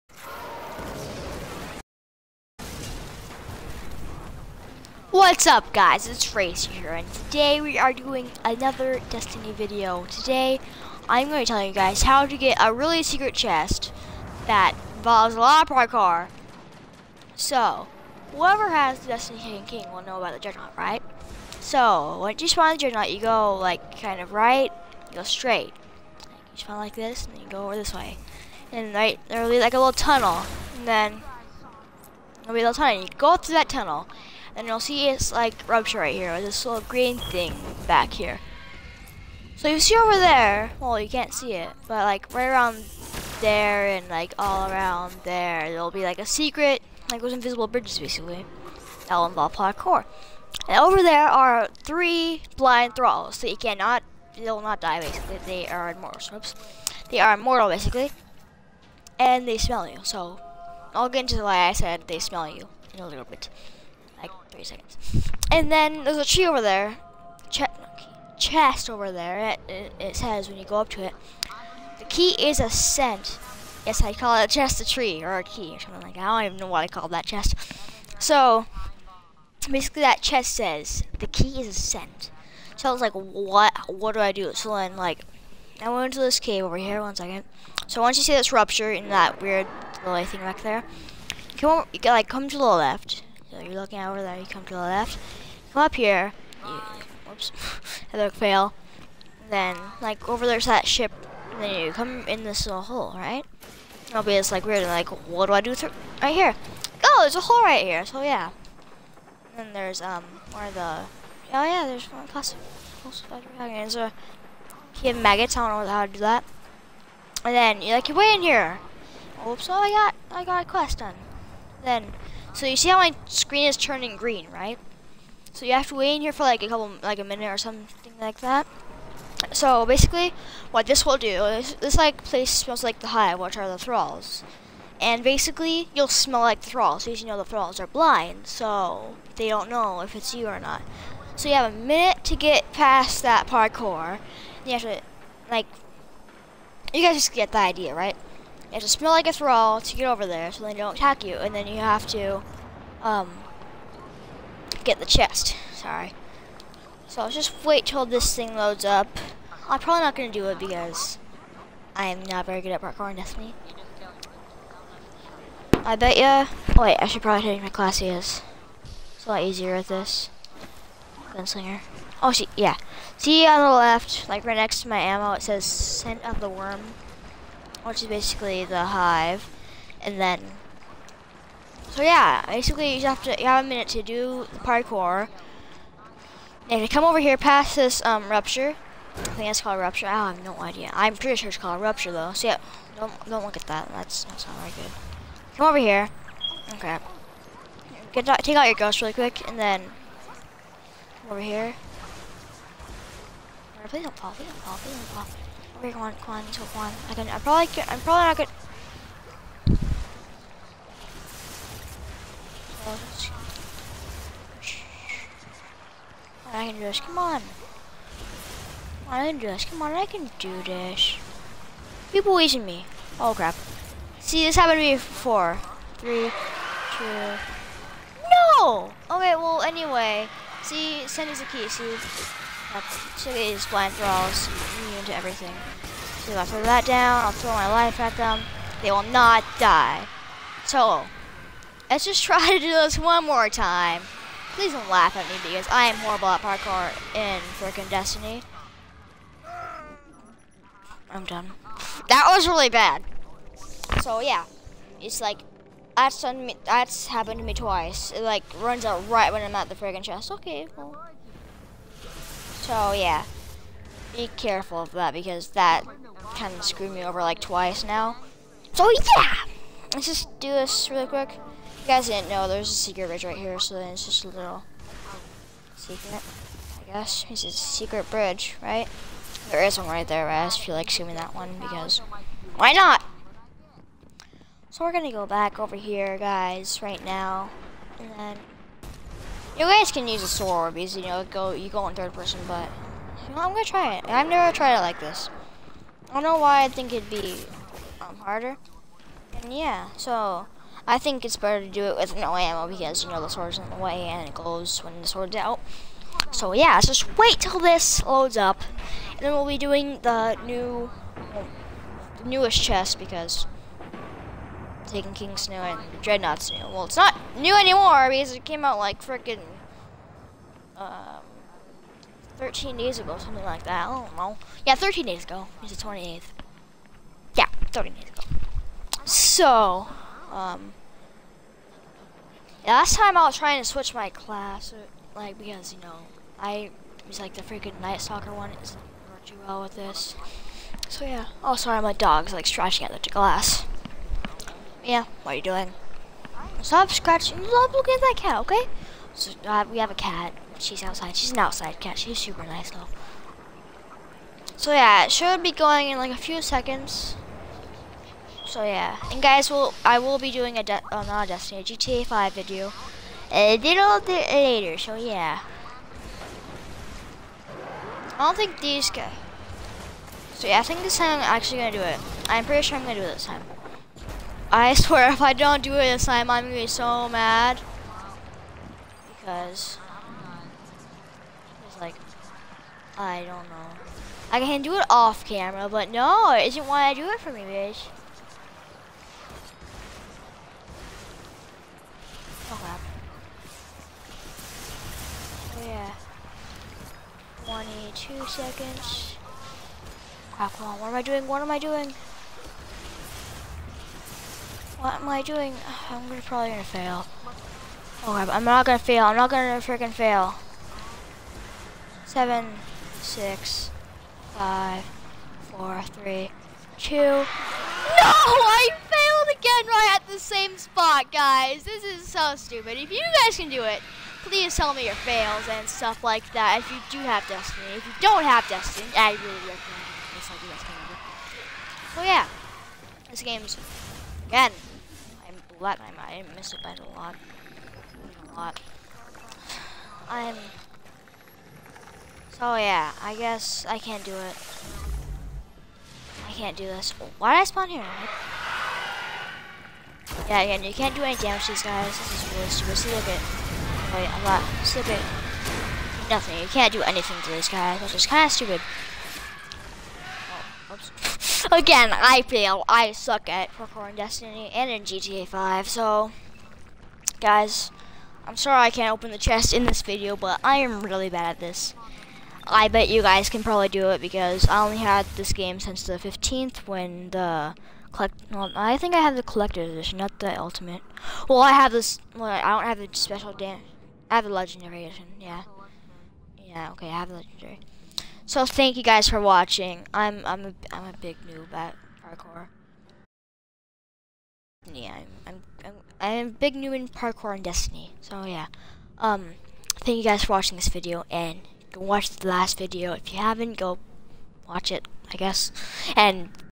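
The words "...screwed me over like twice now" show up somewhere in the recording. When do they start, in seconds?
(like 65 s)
266 s.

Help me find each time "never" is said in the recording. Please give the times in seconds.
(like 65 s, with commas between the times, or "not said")
294 s.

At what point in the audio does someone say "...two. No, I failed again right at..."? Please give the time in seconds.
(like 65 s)
416 s.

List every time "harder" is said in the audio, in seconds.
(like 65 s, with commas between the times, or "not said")
298 s.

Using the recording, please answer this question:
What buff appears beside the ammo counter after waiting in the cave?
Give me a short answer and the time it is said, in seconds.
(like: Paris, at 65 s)
Scent of the Worm, at 175 s.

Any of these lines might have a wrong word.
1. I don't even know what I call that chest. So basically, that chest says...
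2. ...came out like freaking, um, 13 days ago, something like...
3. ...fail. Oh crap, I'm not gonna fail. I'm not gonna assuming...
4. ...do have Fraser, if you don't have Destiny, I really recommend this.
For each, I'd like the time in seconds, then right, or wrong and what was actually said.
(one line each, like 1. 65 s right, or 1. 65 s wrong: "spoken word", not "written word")
1. 76 s right
2. 318 s right
3. 406 s wrong: "freaking", not "assuming"
4. 426 s wrong: "Destiny", not "Fraser".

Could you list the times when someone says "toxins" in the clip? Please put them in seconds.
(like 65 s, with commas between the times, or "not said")
not said.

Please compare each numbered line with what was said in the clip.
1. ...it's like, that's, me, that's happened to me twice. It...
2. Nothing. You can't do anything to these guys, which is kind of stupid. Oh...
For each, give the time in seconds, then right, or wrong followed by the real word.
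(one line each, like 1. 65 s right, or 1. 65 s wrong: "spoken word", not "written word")
1. 255 s right
2. 456 s right.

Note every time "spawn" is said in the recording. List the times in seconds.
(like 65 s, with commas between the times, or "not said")
22 s, 26 s, 447 s.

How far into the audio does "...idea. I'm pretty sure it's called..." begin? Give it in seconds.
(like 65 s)
190 s.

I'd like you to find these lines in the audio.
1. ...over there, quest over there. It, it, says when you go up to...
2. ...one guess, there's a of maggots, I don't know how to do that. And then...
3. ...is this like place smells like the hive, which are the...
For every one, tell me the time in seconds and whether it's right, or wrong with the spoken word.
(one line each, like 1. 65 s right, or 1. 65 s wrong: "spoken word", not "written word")
1. 66 s wrong: "chest", not "quest"
2. 112 s wrong: "class", not "guess"
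3. 131 s right.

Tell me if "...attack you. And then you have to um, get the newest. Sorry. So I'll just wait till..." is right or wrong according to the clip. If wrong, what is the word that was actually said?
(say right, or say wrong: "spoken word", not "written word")
wrong: "chest", not "newest".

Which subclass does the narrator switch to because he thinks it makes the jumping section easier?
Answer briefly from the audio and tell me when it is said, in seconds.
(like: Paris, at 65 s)
Gunslinger, at 171 s.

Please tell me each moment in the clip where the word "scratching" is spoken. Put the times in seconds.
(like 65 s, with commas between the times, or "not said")
342 s, 346 s.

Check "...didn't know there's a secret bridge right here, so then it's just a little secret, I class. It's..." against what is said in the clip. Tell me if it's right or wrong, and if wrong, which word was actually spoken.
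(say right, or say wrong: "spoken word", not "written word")
wrong: "guess", not "class".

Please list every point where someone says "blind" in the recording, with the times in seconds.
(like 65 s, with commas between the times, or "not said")
52 s, 137 s, 233 s.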